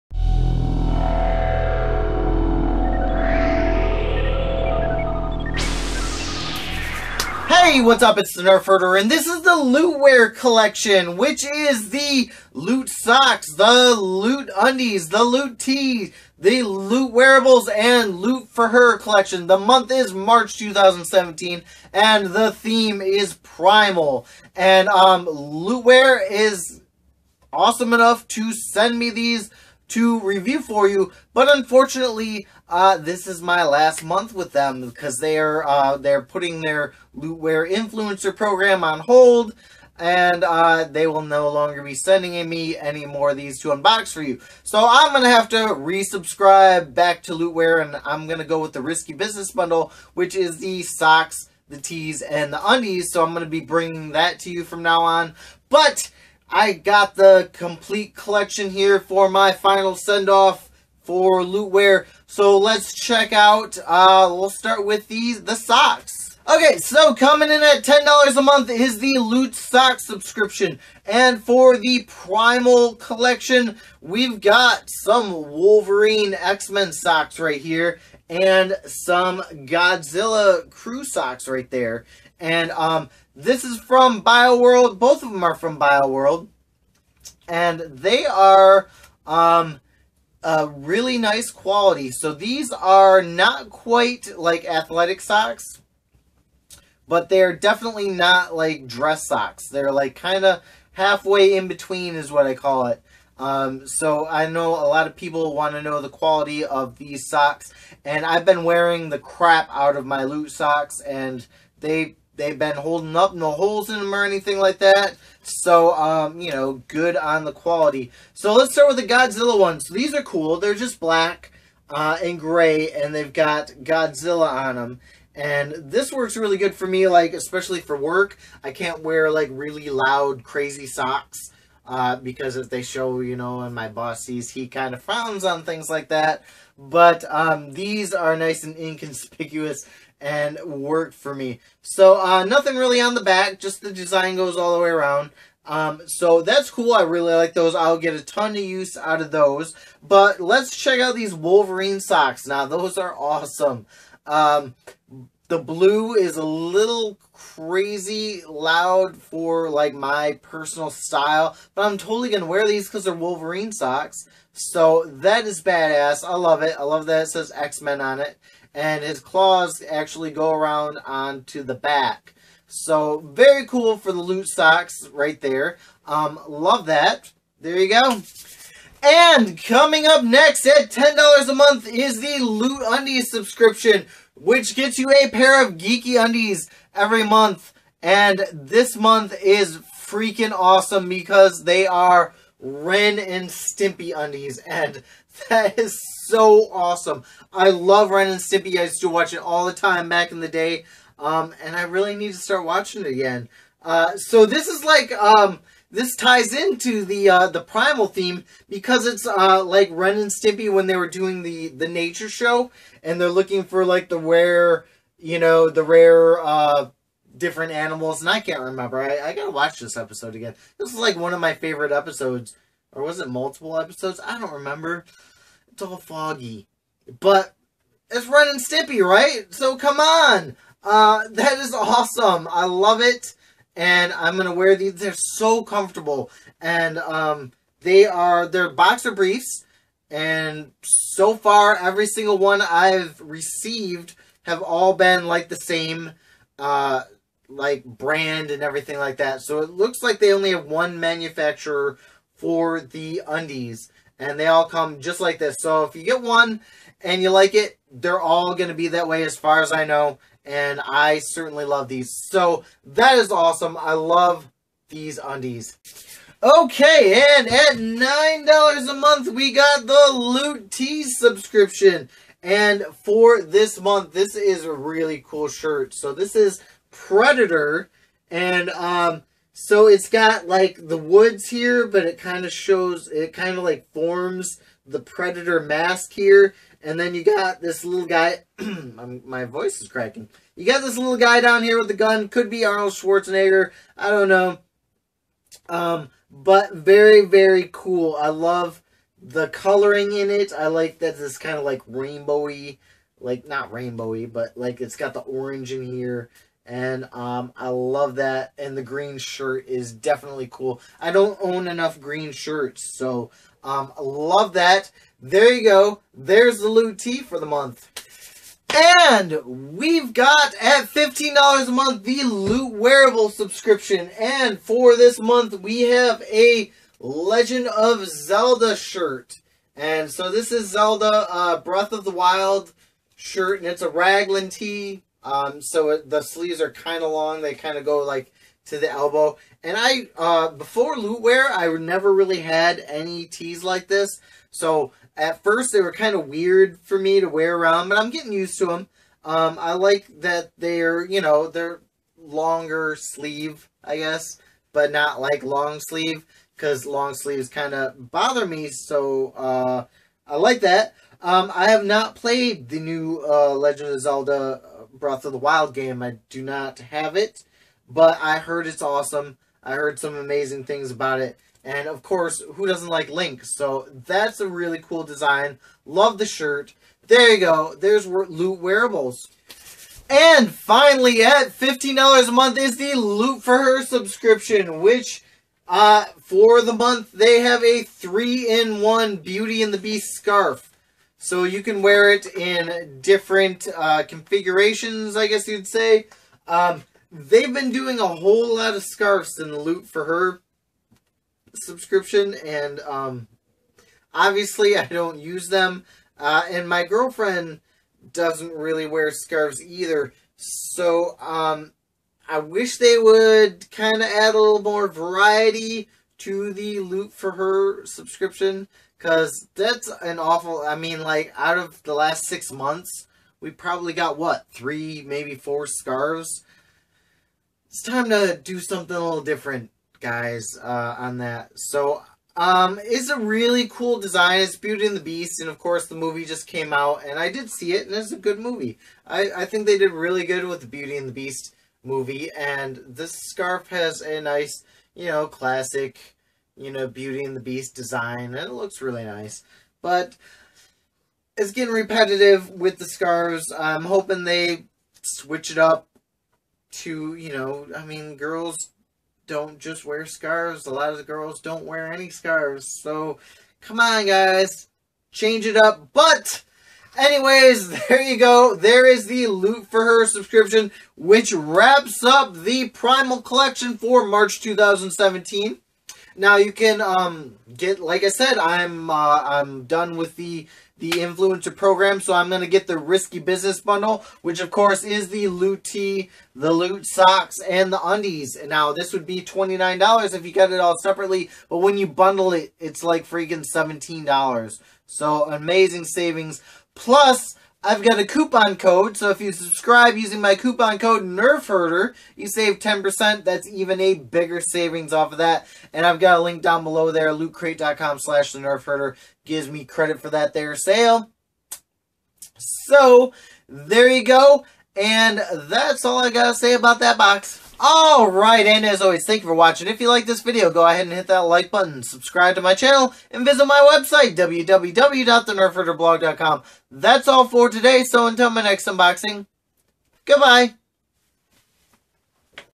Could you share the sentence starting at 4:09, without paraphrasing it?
So it looks like they only have one manufacturer for the undies, and they all come just like this.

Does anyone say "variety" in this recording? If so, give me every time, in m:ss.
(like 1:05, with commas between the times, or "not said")
6:54.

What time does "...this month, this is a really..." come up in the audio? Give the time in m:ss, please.
4:33.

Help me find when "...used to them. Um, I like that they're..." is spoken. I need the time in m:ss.
5:48.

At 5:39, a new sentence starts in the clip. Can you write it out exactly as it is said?
And I, uh, before wear, I never really had any tees like this.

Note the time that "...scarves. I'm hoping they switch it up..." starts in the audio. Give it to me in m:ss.
7:32.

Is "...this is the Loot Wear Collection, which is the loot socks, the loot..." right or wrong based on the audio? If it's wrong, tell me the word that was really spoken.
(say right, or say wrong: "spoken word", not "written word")
right.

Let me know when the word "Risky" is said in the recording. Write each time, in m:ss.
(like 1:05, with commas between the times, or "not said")
0:48, 8:02.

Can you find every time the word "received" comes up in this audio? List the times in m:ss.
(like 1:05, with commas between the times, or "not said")
4:03.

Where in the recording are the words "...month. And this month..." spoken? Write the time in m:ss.
3:07.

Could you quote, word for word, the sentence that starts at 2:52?
So very cool for the loot socks right there.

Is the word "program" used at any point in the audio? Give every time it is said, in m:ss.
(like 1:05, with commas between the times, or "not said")
0:38, 8:01.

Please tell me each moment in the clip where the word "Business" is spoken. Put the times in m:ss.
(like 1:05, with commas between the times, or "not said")
0:49, 8:03.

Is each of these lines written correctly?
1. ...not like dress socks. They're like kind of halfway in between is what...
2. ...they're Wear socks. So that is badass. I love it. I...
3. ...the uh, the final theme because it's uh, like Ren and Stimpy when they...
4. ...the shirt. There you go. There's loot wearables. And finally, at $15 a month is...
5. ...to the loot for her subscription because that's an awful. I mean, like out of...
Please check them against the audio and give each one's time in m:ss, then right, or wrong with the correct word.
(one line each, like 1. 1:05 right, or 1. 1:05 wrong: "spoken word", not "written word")
1. 1:38 right
2. 2:43 wrong: "Wolverine", not "Wear"
3. 3:27 wrong: "primal", not "final"
4. 6:16 right
5. 6:56 right.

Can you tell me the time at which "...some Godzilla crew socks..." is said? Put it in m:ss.
1:18.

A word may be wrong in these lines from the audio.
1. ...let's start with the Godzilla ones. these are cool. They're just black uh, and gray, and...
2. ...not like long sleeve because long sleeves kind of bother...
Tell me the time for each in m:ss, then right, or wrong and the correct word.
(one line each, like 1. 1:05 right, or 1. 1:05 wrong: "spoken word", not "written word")
1. 1:58 right
2. 5:54 right.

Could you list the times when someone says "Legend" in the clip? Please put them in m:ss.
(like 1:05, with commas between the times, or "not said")
5:26, 6:03.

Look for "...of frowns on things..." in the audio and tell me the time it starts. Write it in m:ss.
2:14.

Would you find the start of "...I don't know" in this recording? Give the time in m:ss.
4:53.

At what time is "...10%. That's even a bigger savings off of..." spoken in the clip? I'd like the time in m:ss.
8:22.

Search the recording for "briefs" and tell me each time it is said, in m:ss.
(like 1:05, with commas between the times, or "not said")
3:59.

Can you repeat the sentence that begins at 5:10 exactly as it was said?
I don't own enough green shirts, so um, I love that.